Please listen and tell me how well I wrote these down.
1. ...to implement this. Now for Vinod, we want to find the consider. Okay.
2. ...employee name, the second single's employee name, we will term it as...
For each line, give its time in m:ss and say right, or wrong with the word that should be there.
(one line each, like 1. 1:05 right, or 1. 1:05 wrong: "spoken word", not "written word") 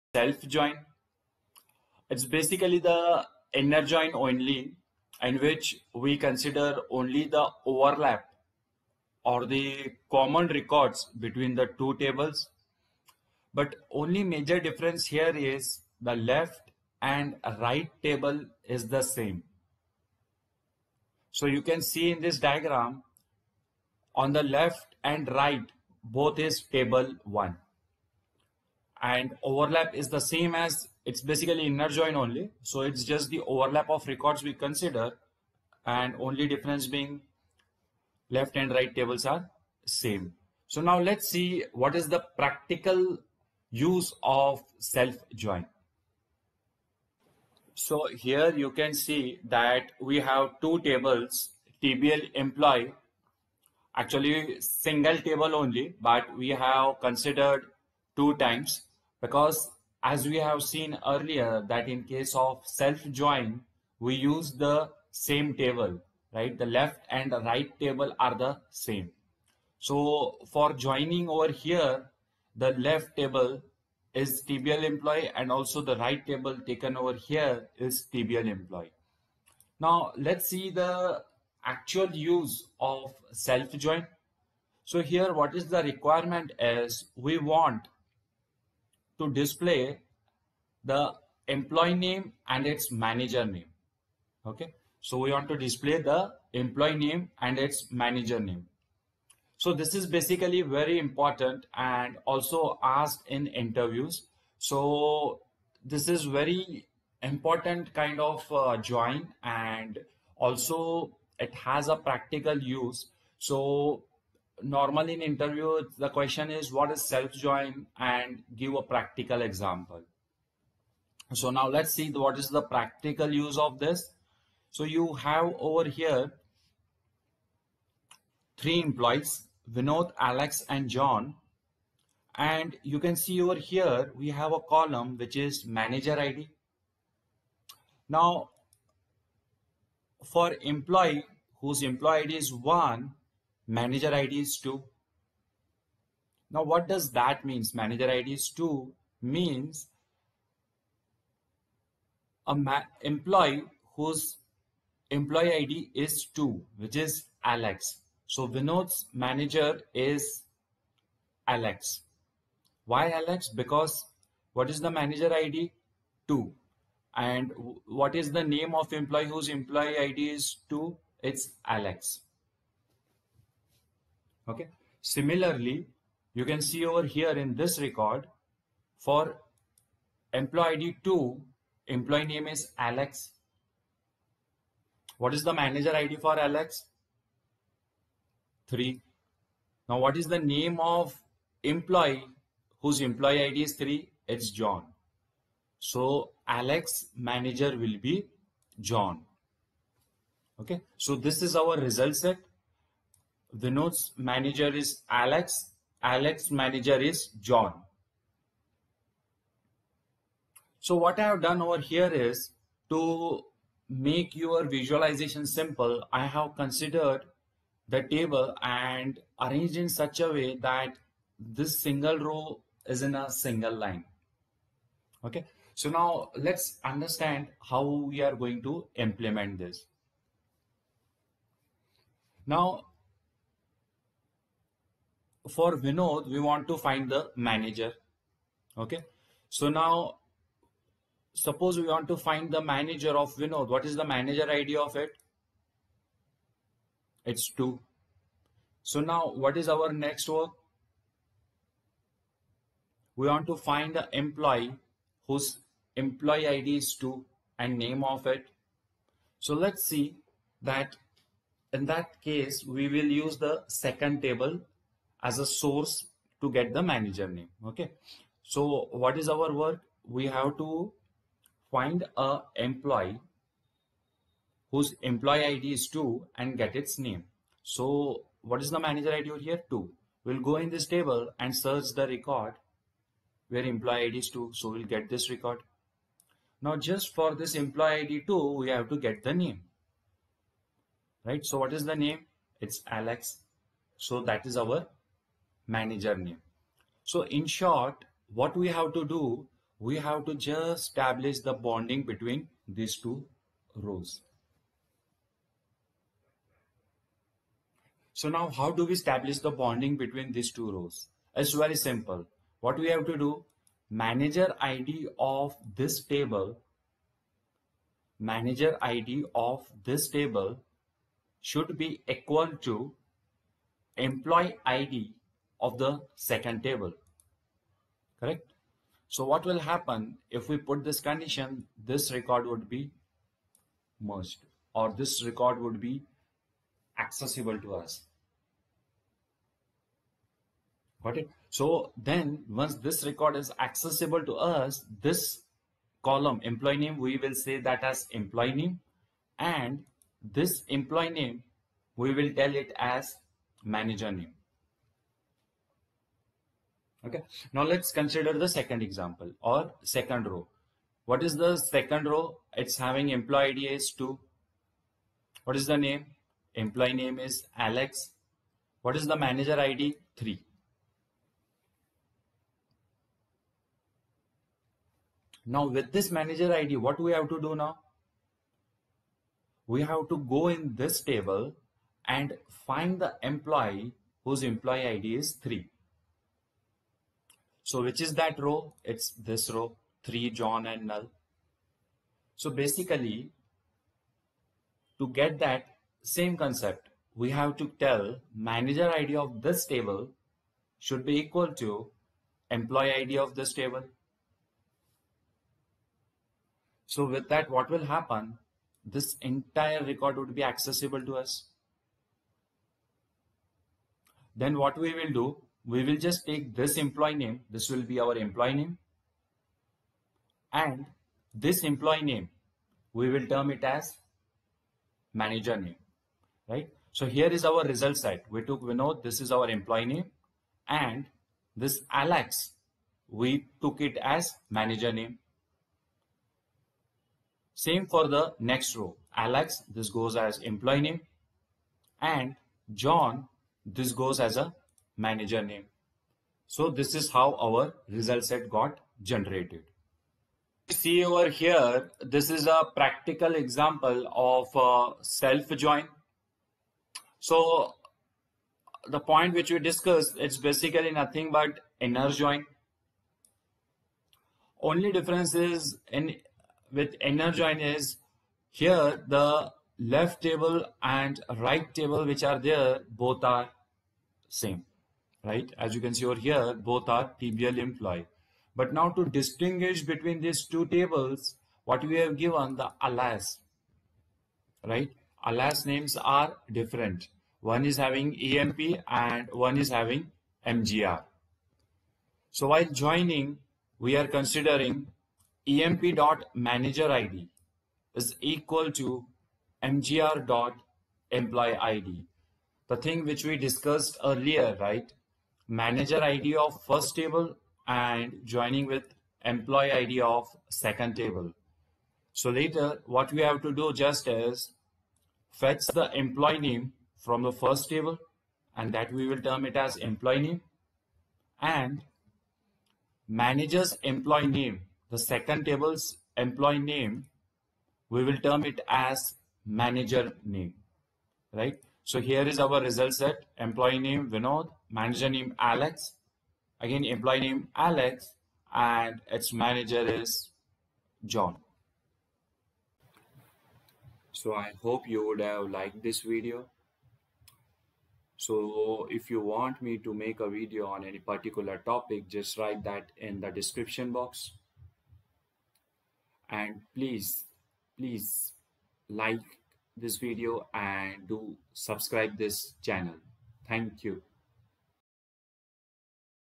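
1. 3:48 wrong: "manager", not "consider"
2. 8:43 wrong: "table", not "single".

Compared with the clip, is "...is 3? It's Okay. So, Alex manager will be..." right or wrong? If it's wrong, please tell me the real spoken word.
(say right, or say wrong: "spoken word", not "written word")
wrong: "John", not "Okay".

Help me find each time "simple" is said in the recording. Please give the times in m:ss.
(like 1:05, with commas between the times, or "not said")
3:35, 5:11.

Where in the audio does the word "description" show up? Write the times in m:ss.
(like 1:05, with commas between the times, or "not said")
9:13.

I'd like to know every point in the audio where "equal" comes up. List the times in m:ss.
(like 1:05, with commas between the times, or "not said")
5:22, 6:41, 8:18.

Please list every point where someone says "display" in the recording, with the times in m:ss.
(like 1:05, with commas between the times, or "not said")
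1:29, 1:35.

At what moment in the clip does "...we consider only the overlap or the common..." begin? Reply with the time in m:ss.
0:05.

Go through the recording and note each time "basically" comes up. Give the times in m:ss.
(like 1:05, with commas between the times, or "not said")
0:02, 0:31, 1:40, 6:32, 7:40.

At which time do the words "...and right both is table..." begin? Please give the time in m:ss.
0:25.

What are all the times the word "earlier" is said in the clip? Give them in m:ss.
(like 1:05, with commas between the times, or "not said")
1:01, 8:24.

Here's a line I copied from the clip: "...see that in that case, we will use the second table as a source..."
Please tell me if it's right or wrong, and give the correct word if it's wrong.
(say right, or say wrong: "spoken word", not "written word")
right.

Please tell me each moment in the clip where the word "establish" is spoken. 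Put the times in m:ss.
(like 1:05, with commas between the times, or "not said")
5:00, 5:08.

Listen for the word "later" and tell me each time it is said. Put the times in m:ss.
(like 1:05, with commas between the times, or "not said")
8:32.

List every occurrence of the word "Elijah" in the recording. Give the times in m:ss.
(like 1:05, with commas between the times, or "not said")
not said.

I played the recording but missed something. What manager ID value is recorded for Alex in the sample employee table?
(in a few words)
3.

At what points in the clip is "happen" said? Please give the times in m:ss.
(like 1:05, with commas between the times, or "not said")
5:29, 6:47.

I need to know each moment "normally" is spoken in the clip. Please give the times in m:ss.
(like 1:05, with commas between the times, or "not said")
1:54.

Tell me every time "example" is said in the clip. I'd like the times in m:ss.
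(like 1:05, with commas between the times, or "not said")
1:59, 5:58, 7:33.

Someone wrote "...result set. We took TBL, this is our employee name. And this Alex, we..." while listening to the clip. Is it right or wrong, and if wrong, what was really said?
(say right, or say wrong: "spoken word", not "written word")
wrong: "Vinod", not "TBL".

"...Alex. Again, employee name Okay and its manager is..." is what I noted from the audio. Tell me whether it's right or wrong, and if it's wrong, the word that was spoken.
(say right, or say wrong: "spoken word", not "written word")
wrong: "Alex", not "Okay".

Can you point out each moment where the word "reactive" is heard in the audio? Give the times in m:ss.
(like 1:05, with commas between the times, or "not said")
not said.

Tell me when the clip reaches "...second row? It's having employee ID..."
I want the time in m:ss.
6:01.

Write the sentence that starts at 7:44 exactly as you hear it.
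Only difference is in with inner join is here the left table and right table which are there both are same right?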